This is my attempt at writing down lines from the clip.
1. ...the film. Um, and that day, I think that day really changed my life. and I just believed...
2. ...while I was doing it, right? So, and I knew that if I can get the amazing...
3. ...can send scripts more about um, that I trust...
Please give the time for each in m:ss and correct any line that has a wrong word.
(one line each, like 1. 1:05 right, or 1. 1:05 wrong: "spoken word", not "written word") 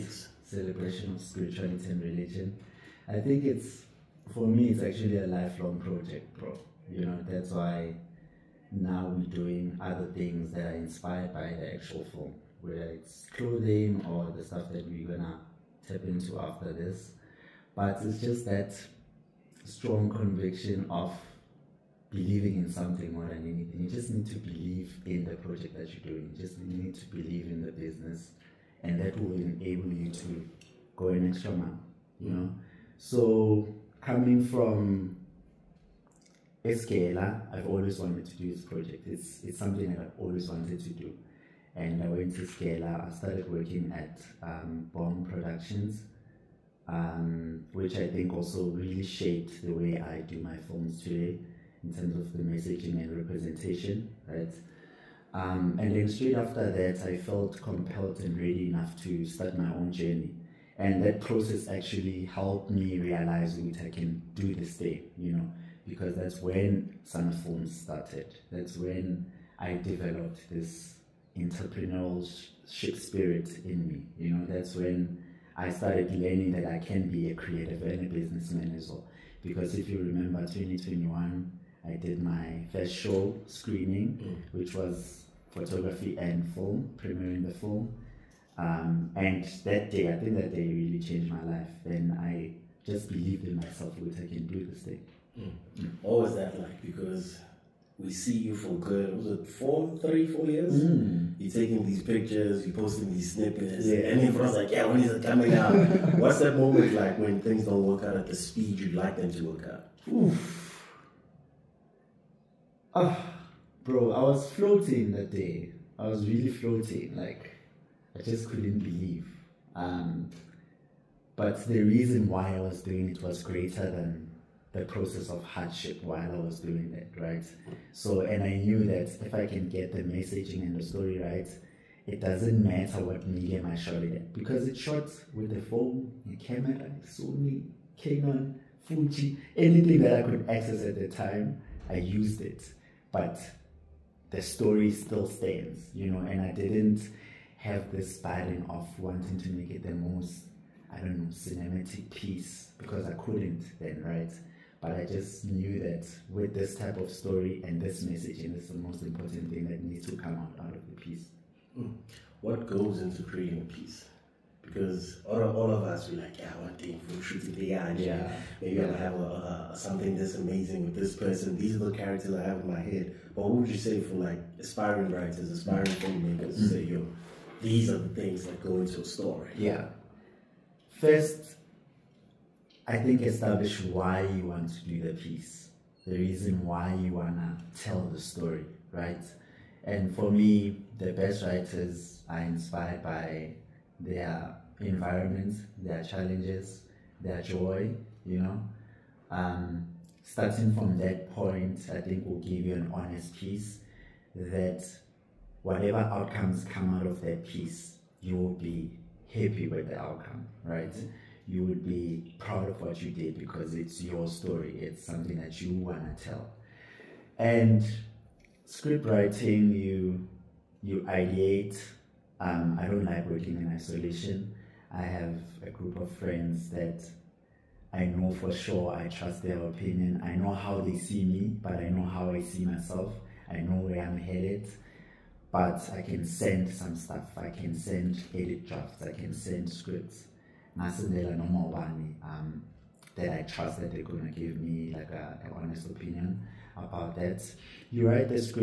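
1. 1:27 right
2. 2:06 wrong: "messaging", not "amazing"
3. 3:59 right.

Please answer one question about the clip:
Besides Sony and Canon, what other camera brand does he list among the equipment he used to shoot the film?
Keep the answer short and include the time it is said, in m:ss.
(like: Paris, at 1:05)
Fuji, at 2:18.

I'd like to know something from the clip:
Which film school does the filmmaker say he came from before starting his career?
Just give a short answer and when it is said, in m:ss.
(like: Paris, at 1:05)
Escala, at 0:36.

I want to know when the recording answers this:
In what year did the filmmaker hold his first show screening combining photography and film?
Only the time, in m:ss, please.
1:20.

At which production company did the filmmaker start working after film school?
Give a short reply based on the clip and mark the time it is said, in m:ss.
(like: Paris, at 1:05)
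Bomb Productions, at 0:44.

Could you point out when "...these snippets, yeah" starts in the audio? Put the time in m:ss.
1:43.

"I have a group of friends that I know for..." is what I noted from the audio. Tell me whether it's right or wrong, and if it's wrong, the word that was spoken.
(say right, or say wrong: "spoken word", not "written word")
right.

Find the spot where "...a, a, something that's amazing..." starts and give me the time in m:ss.
2:49.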